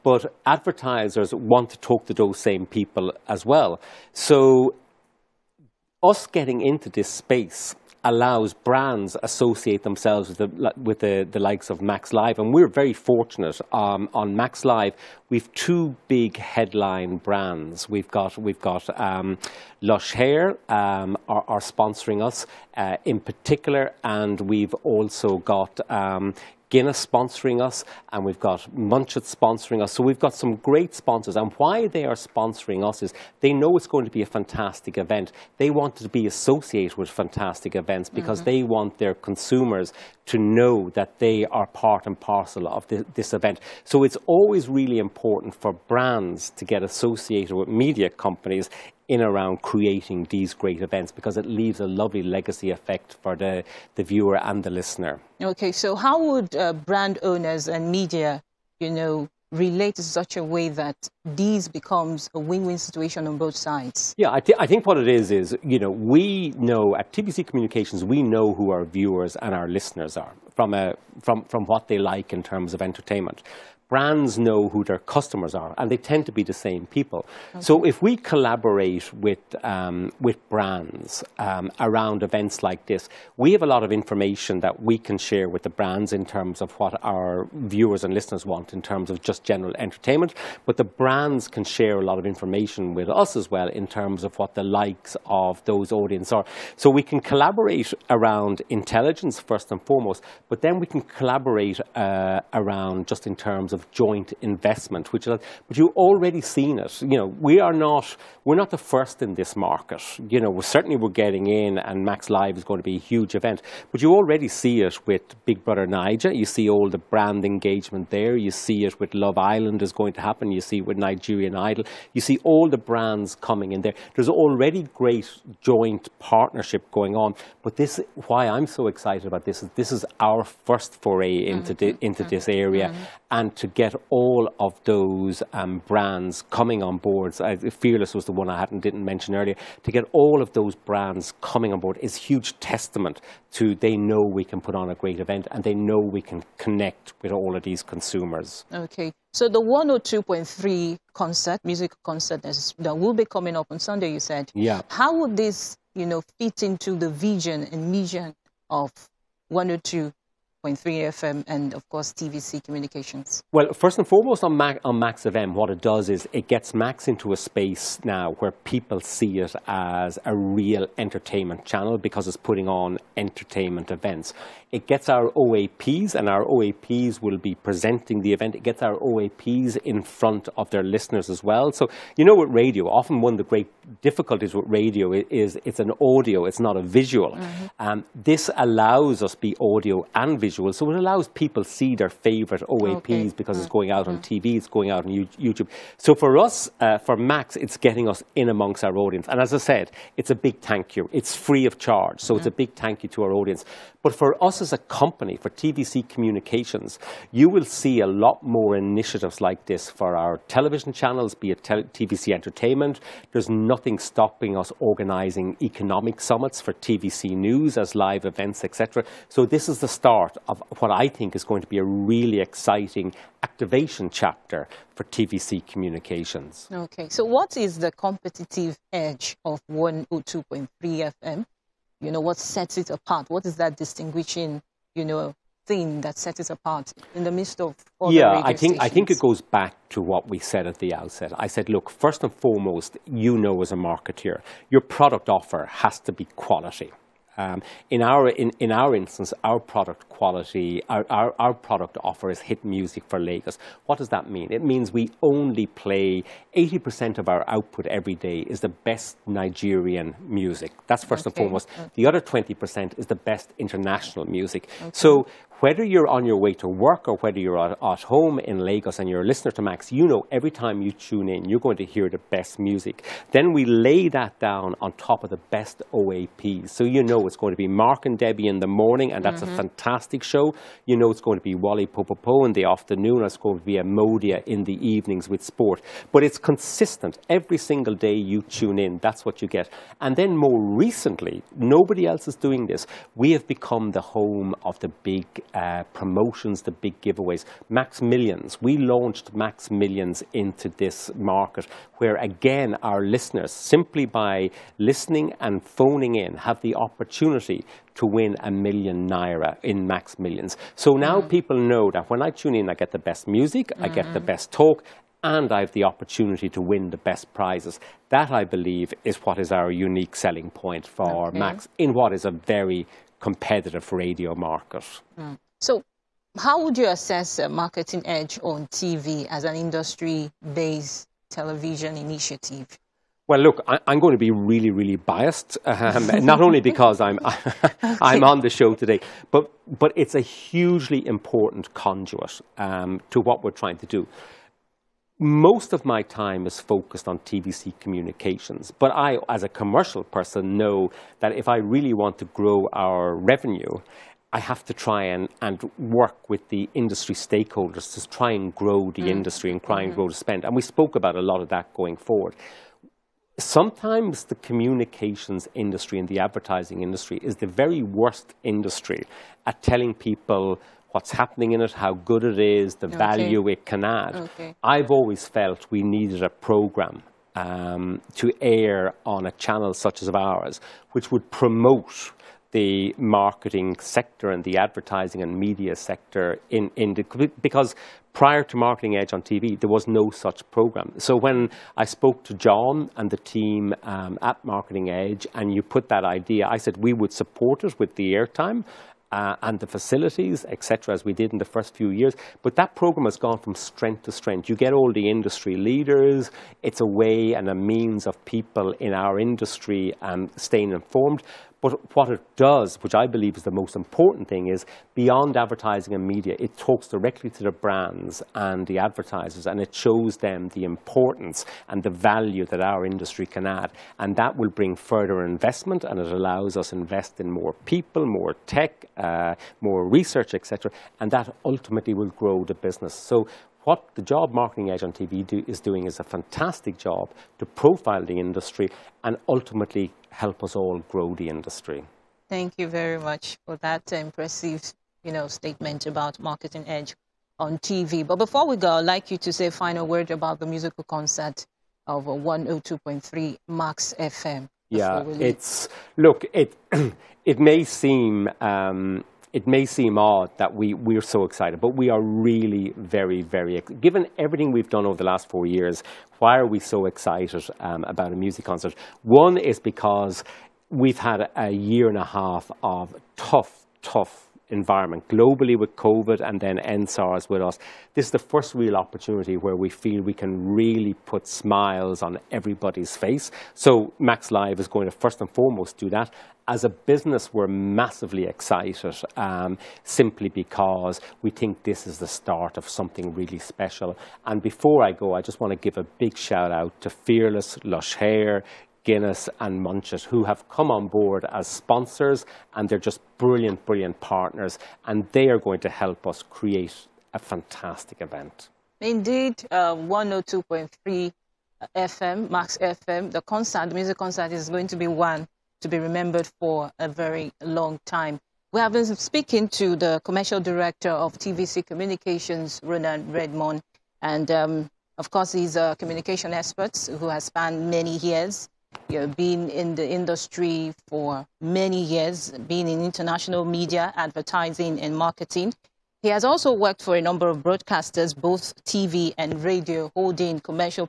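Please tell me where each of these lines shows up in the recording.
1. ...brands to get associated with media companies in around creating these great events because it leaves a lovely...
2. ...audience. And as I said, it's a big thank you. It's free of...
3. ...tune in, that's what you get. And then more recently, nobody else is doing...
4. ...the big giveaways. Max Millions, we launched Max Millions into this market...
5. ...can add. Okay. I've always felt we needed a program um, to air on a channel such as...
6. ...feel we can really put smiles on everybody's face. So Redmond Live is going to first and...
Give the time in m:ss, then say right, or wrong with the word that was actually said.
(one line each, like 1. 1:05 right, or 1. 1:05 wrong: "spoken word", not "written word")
1. 0:45 right
2. 3:18 right
3. 4:48 right
4. 4:56 right
5. 6:13 right
6. 7:59 wrong: "Max", not "Redmond".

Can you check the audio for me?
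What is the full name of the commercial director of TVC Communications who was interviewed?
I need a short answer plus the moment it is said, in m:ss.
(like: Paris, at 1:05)
Ronan Redmond, at 8:42.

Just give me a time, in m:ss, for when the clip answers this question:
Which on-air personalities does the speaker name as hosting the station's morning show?
4:37.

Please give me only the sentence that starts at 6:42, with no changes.
But that program has gone from strength to strength.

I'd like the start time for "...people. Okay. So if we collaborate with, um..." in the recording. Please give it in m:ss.
1:16.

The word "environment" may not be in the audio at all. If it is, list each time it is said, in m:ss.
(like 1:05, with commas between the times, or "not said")
7:54.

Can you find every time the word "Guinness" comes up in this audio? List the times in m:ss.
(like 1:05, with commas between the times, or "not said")
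0:26, 8:18.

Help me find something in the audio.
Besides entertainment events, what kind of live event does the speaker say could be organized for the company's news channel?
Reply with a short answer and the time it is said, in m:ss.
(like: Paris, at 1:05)
economic summits, at 3:35.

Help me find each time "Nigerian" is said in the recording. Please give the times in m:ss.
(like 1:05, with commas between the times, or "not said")
2:00, 4:19.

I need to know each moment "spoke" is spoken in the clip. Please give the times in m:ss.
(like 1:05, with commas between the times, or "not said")
6:00, 6:31.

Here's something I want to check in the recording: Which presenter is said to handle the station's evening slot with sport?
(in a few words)
Amodia.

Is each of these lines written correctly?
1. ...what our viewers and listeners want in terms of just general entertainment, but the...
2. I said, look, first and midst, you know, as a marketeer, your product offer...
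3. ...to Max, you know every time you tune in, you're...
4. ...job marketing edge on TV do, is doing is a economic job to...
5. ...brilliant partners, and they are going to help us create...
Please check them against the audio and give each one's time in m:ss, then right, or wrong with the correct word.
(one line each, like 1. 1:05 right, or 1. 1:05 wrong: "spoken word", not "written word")
1. 1:26 right
2. 4:01 wrong: "foremost", not "midst"
3. 4:29 right
4. 7:14 wrong: "fantastic", not "economic"
5. 8:23 right.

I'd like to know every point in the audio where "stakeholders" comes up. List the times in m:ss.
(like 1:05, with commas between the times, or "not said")
5:57.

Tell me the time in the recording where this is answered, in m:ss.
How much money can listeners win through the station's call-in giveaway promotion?
5:08.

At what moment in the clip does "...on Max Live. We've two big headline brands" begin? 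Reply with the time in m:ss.
0:14.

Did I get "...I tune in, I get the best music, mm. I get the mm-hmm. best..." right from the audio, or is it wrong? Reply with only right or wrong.
right.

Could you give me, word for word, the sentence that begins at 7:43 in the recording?
Given everything we've done over the last four years, why are we so excited um, about a music concert?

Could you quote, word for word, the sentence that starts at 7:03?
And that will bring further investment, and it allows us to invest in more people, more tech, uh, more research, etc.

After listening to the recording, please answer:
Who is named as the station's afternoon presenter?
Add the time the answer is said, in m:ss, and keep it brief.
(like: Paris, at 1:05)
Wally Popopo, at 4:41.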